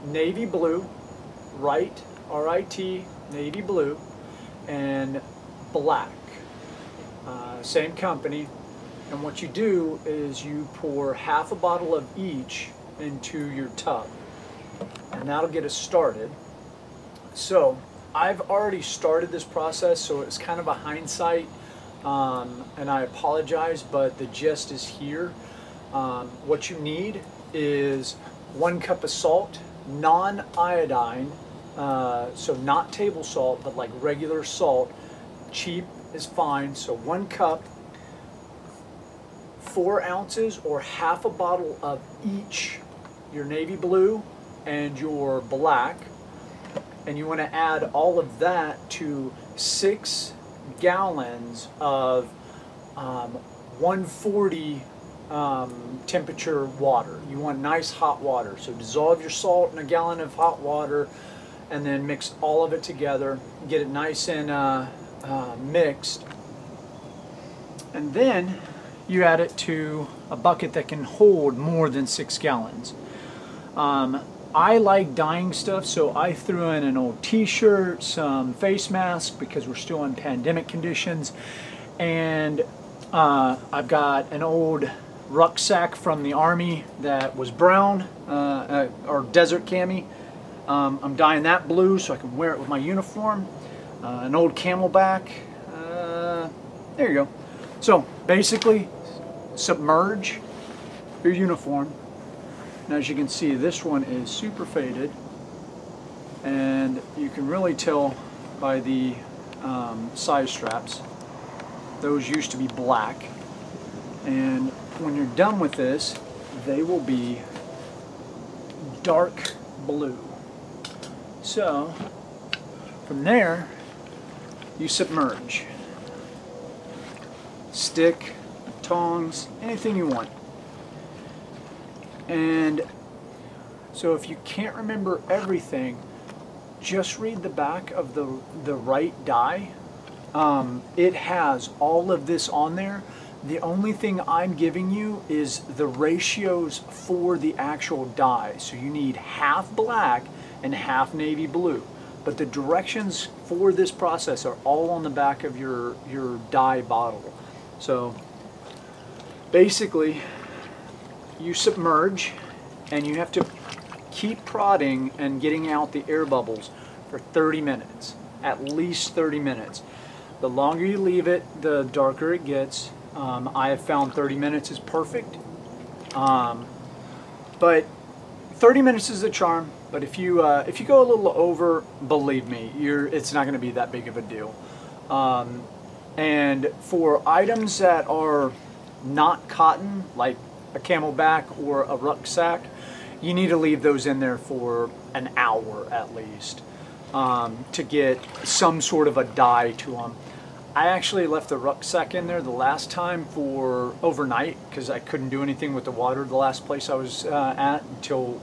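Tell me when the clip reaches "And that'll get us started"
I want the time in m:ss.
0:15.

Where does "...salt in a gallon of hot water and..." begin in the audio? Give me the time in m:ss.
0:59.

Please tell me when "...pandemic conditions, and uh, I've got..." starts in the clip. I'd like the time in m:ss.
1:20.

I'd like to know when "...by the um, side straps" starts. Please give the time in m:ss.
1:48.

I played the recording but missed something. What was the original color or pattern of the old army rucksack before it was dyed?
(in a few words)
desert cami.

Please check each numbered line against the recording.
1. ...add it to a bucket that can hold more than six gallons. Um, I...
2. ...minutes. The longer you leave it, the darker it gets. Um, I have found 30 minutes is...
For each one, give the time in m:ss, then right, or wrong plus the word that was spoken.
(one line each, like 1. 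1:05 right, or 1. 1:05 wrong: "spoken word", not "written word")
1. 1:09 right
2. 2:49 right.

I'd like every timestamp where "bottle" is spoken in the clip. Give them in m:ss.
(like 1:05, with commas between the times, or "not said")
0:11, 0:41, 2:36.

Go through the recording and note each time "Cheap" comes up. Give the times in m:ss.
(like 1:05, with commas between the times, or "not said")
0:35.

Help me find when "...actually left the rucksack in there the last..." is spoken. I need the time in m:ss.
3:20.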